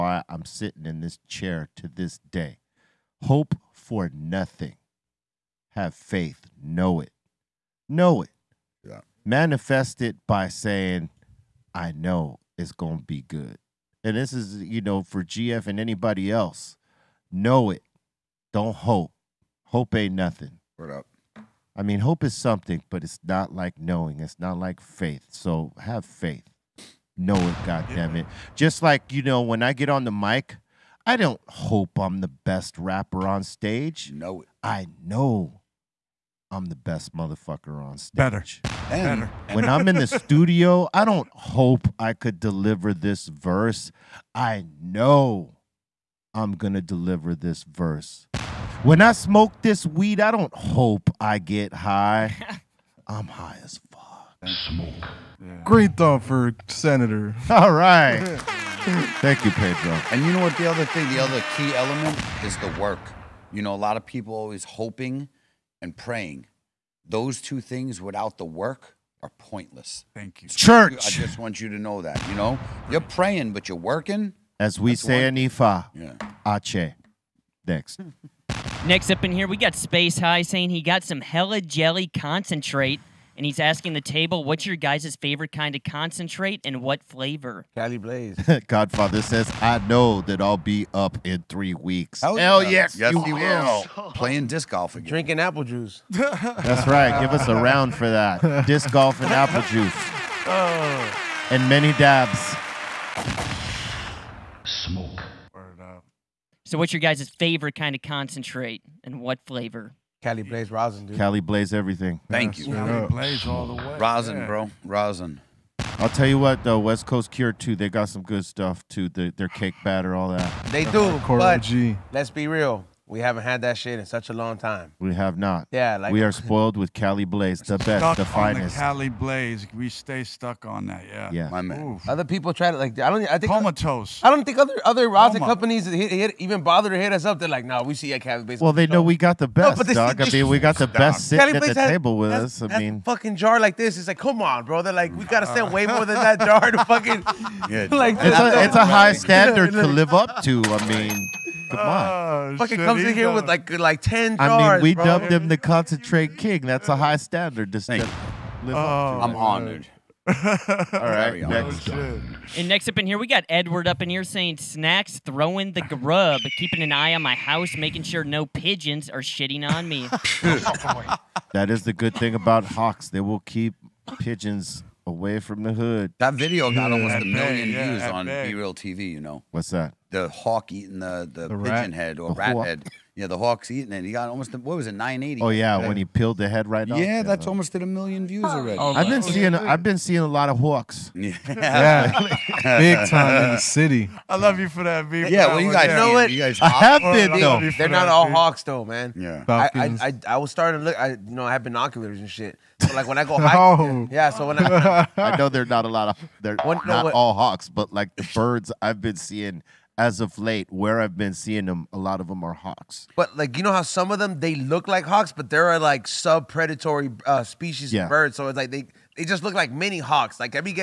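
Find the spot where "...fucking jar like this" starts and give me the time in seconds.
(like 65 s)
143 s.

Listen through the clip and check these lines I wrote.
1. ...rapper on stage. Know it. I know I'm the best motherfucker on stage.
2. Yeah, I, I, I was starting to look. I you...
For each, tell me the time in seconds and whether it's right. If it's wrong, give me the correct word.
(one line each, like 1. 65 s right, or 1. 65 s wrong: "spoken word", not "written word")
1. 32 s right
2. 199 s right.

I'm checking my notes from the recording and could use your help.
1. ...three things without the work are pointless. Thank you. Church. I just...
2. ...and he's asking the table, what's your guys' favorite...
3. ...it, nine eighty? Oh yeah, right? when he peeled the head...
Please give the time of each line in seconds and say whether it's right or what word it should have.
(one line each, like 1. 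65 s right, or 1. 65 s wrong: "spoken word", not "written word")
1. 67 s wrong: "two", not "three"
2. 83 s right
3. 184 s right.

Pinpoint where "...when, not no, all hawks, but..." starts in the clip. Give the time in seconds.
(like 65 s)
206 s.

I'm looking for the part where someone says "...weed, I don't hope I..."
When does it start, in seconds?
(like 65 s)
49 s.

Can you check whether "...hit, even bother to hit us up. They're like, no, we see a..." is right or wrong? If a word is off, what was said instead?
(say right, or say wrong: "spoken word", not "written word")
right.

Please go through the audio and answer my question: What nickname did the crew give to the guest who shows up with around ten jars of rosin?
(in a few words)
Concentrate king.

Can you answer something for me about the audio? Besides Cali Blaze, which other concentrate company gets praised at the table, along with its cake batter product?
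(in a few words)
West Coast Cure.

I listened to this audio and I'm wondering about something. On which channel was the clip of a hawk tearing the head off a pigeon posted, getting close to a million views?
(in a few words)
B-Real TV.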